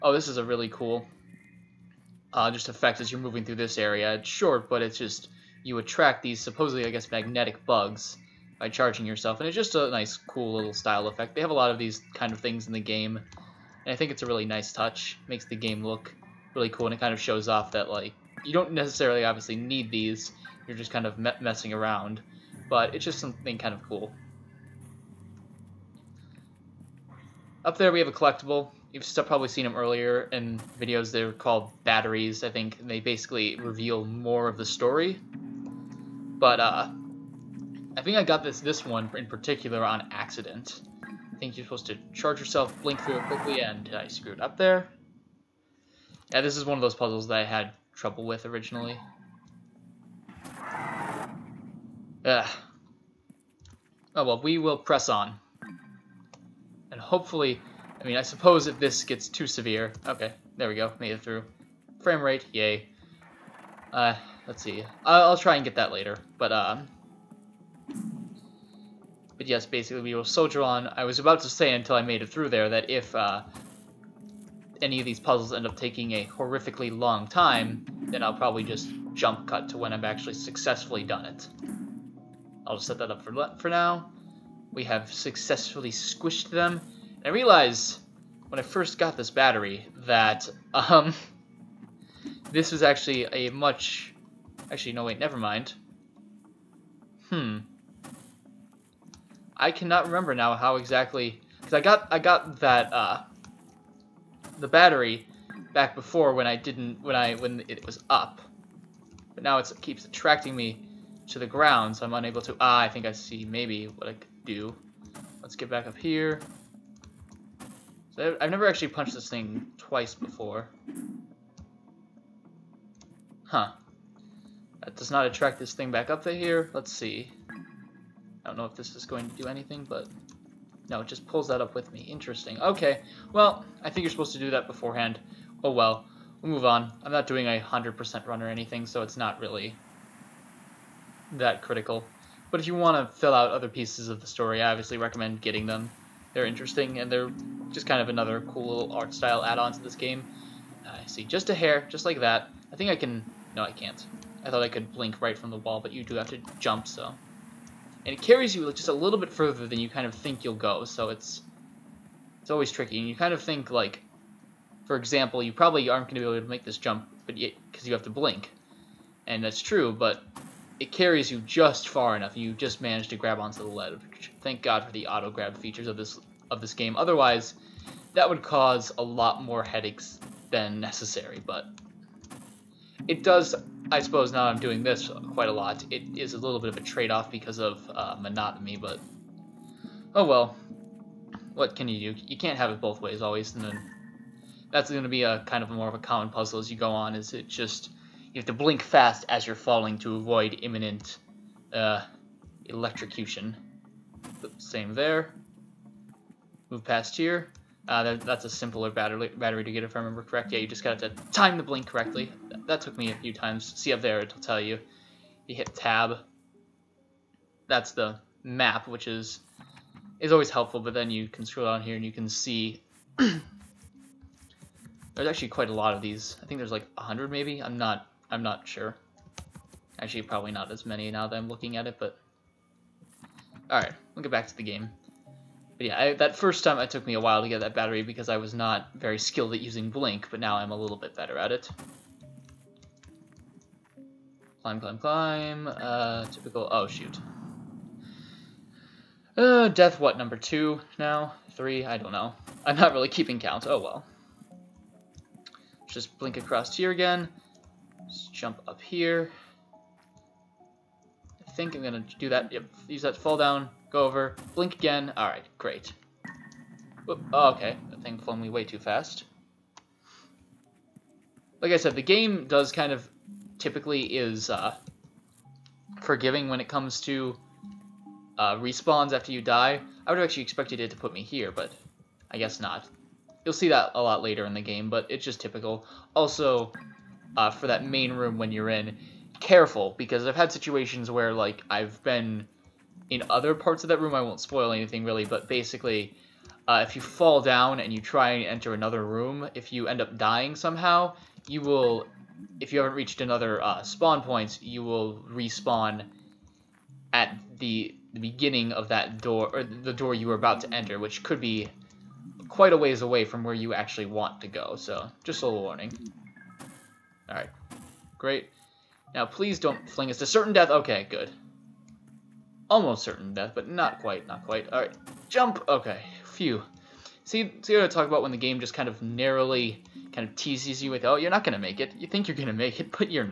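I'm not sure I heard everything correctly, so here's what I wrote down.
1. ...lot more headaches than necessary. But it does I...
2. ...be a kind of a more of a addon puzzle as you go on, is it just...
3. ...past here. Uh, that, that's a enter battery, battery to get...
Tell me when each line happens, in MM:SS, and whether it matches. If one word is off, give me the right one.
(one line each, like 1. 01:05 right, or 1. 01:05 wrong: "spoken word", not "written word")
1. 02:59 right
2. 03:15 wrong: "common", not "addon"
3. 03:26 wrong: "simpler", not "enter".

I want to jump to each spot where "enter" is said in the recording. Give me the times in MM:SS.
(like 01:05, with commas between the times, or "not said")
04:58, 05:10.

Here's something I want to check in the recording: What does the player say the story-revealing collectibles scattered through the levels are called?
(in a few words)
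batteries.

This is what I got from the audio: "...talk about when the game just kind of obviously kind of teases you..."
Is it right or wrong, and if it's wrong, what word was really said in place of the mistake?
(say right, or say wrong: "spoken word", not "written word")
wrong: "narrowly", not "obviously".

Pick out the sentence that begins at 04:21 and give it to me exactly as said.
I think I'm going to do that.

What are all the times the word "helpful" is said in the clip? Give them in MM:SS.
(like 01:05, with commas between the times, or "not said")
03:40.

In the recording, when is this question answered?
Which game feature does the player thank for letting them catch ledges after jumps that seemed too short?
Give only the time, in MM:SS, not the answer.
02:55.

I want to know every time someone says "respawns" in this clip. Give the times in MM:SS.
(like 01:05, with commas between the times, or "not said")
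04:38, 05:05.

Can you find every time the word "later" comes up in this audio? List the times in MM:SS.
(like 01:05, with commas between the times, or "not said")
01:05, 04:44.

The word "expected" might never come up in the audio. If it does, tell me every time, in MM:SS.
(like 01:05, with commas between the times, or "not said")
04:40.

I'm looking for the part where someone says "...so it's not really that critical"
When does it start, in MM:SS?
02:18.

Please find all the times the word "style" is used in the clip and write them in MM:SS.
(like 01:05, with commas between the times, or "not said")
00:10, 02:29.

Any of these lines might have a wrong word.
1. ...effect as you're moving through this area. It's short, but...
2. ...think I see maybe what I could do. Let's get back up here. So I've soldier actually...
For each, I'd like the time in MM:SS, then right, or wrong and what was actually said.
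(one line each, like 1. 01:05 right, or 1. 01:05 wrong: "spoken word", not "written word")
1. 00:02 right
2. 01:52 wrong: "never", not "soldier".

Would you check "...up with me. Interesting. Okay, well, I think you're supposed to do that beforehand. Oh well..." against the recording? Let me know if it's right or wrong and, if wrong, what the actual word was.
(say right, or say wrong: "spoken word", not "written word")
right.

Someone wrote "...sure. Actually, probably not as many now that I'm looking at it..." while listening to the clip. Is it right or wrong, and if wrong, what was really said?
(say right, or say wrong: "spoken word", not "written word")
right.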